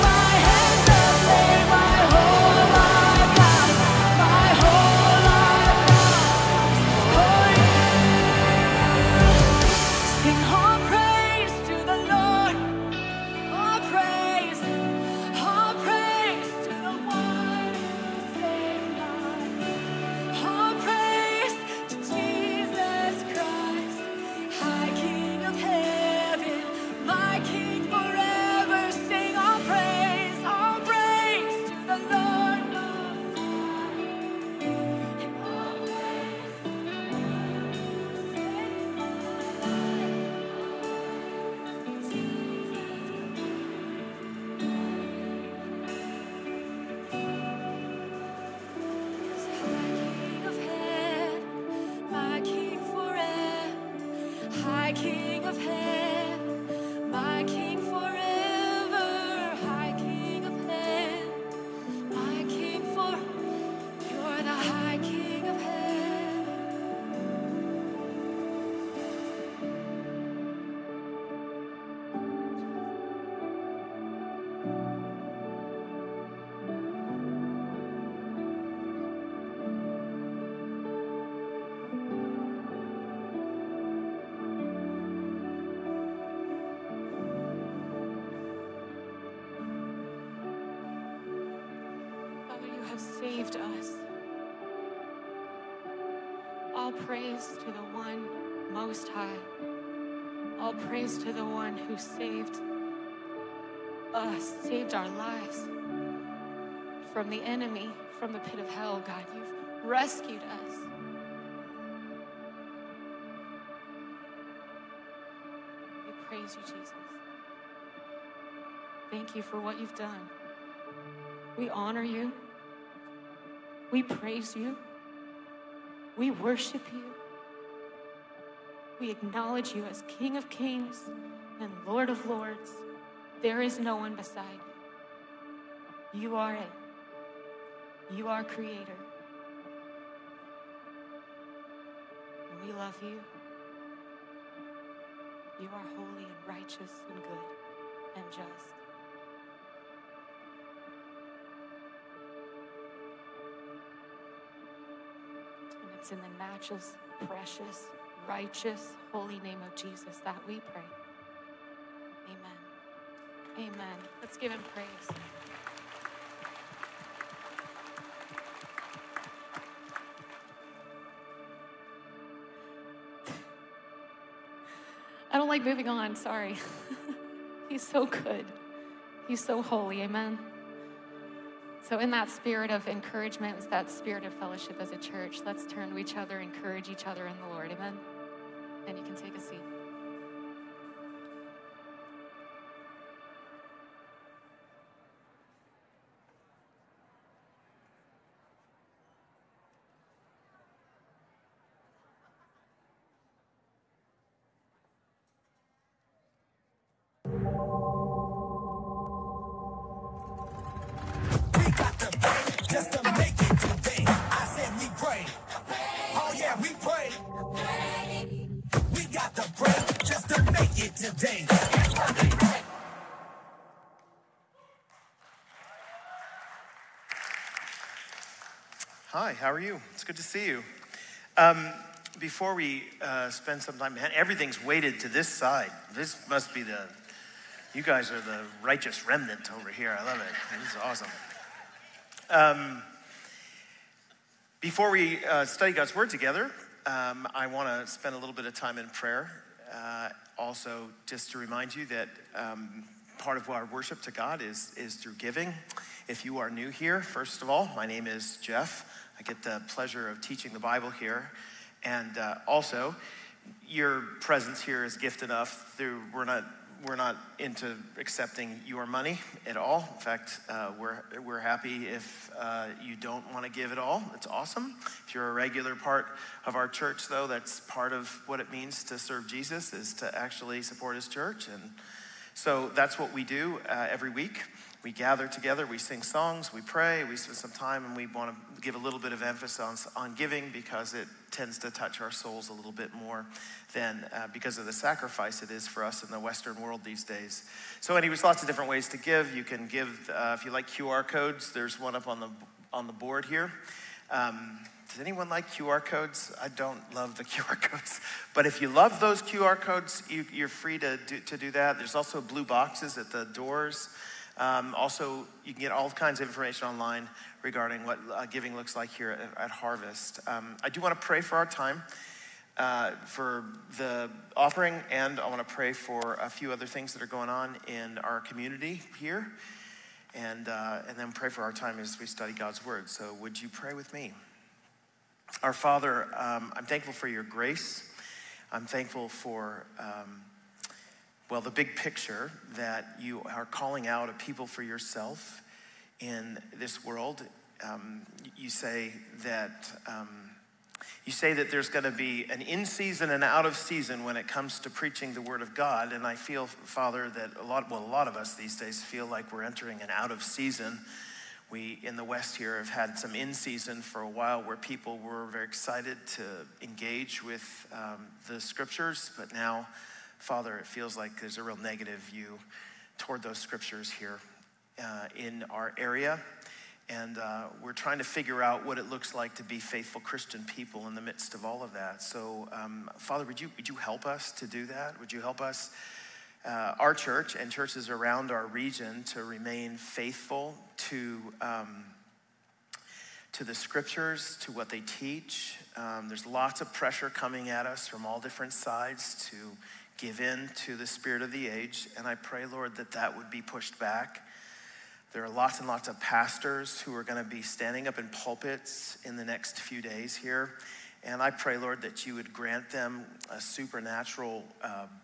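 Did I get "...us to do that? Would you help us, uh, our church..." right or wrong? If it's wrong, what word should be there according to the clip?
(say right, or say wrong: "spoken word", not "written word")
right.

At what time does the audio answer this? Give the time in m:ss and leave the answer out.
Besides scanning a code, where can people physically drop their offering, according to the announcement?
5:12.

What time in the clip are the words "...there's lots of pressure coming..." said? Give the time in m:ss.
6:36.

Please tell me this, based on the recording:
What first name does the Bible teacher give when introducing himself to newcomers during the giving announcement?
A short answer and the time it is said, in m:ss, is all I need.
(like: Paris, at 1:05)
Jeff, at 4:18.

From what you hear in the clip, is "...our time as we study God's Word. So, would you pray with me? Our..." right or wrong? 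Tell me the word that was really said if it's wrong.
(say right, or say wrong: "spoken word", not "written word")
right.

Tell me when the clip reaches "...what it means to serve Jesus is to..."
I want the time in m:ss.
4:38.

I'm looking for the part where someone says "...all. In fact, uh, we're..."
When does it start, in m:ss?
4:29.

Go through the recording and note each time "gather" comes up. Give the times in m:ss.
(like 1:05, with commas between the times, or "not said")
4:44.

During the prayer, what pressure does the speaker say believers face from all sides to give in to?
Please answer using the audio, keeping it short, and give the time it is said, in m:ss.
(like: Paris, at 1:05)
The spirit of the age, at 6:40.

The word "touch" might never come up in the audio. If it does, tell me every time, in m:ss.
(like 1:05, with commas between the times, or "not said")
4:51.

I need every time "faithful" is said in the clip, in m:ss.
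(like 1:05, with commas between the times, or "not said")
6:19, 6:29.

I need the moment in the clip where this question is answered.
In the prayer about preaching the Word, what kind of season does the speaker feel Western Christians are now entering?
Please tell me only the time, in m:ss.
5:59.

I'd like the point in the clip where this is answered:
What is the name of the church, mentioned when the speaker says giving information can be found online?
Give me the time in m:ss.
5:19.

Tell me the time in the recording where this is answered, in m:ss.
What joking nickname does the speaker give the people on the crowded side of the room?
3:58.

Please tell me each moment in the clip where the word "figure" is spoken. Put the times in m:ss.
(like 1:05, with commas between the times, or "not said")
6:18.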